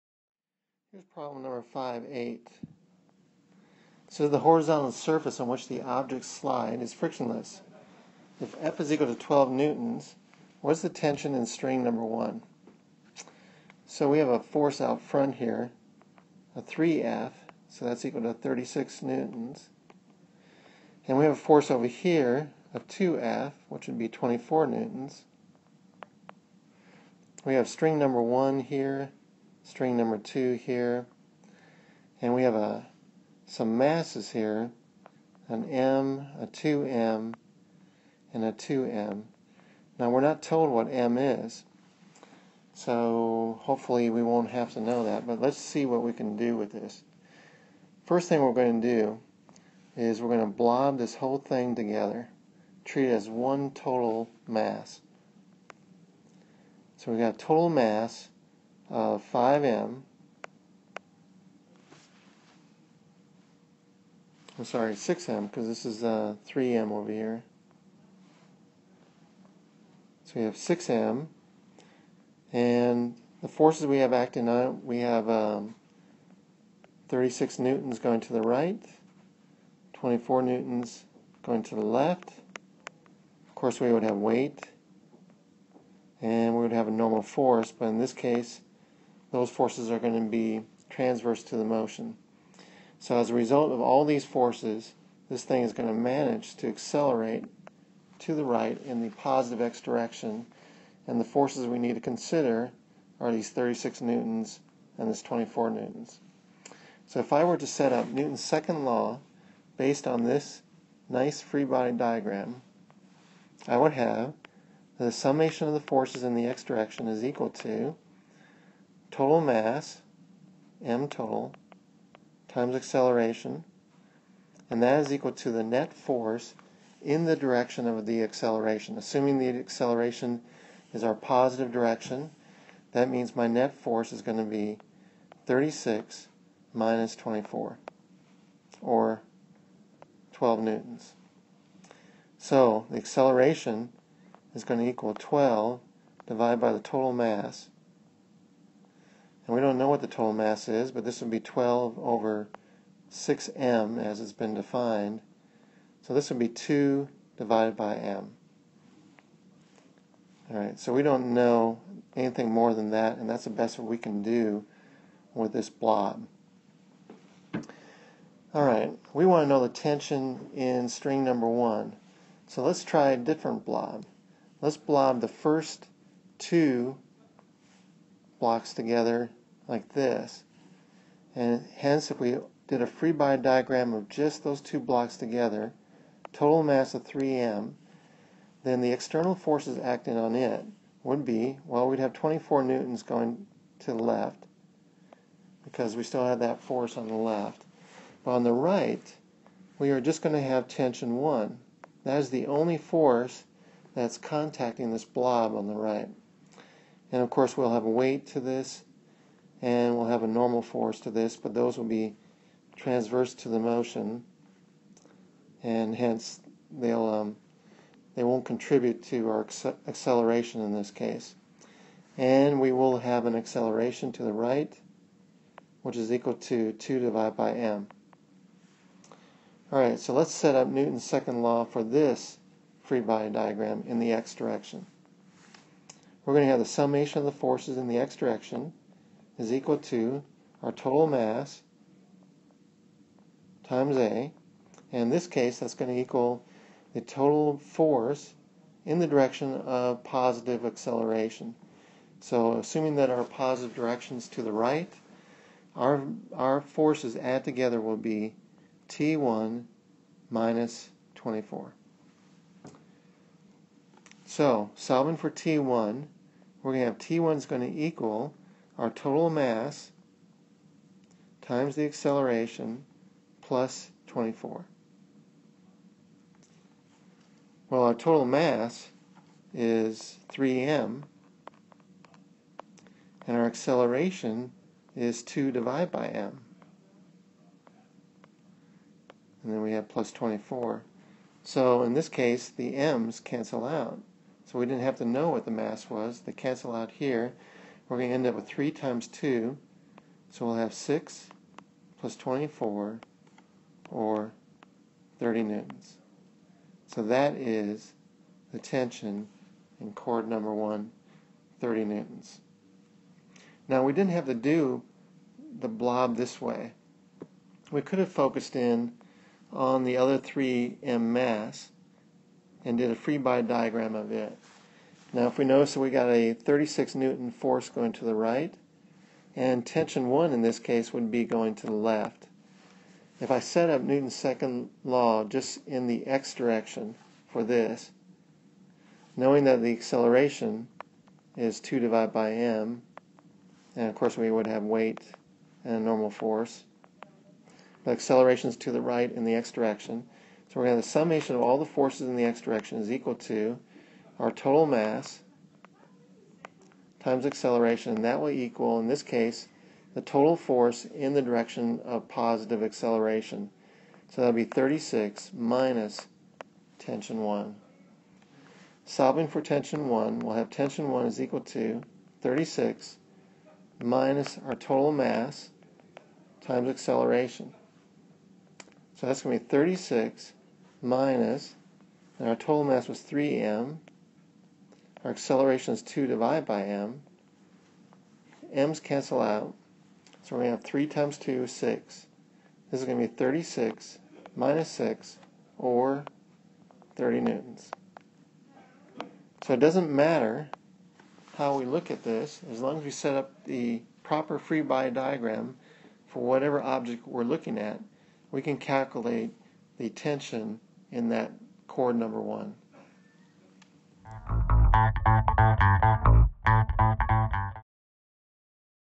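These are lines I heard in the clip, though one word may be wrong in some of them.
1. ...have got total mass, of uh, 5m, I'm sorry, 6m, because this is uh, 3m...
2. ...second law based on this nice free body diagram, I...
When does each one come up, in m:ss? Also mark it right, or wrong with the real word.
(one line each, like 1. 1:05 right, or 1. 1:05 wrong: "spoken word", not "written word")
1. 0:57 right
2. 1:48 right.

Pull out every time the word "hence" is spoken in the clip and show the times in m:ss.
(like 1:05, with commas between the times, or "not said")
3:01, 3:35.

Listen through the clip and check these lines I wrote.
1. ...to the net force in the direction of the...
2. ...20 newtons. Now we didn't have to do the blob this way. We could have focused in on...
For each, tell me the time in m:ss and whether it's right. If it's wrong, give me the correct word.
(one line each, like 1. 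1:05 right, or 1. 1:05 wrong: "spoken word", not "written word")
1. 2:05 right
2. 5:11 wrong: "30", not "20".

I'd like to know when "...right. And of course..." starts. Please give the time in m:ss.
3:25.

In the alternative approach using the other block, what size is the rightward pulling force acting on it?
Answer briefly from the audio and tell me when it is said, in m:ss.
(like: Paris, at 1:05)
36 newtons, at 5:26.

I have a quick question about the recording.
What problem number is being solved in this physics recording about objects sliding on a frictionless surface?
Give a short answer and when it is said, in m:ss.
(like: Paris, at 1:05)
5.8, at 0:01.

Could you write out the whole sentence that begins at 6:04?
So that'll be 36 minus tension 1.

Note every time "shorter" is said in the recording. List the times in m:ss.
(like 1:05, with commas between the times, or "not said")
not said.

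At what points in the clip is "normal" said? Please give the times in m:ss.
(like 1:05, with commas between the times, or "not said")
1:26, 3:30, 5:45.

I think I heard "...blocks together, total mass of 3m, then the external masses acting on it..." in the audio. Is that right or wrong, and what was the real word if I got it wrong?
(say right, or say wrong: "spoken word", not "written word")
wrong: "forces", not "masses".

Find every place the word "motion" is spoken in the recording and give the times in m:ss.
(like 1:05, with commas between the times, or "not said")
1:31, 3:33.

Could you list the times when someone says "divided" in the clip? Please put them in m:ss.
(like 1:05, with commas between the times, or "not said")
2:26, 2:37, 3:46, 4:45, 5:41, 6:26.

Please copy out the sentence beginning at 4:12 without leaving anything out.
So assuming that our positive direction is to the right, our, our forces add together will be T1 minus 24.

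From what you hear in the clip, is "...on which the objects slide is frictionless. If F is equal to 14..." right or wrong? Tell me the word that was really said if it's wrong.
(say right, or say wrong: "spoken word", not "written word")
wrong: "12", not "14".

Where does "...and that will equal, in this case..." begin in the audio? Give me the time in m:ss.
5:57.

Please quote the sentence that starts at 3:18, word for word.
But on the right, we are just going to have tension 1.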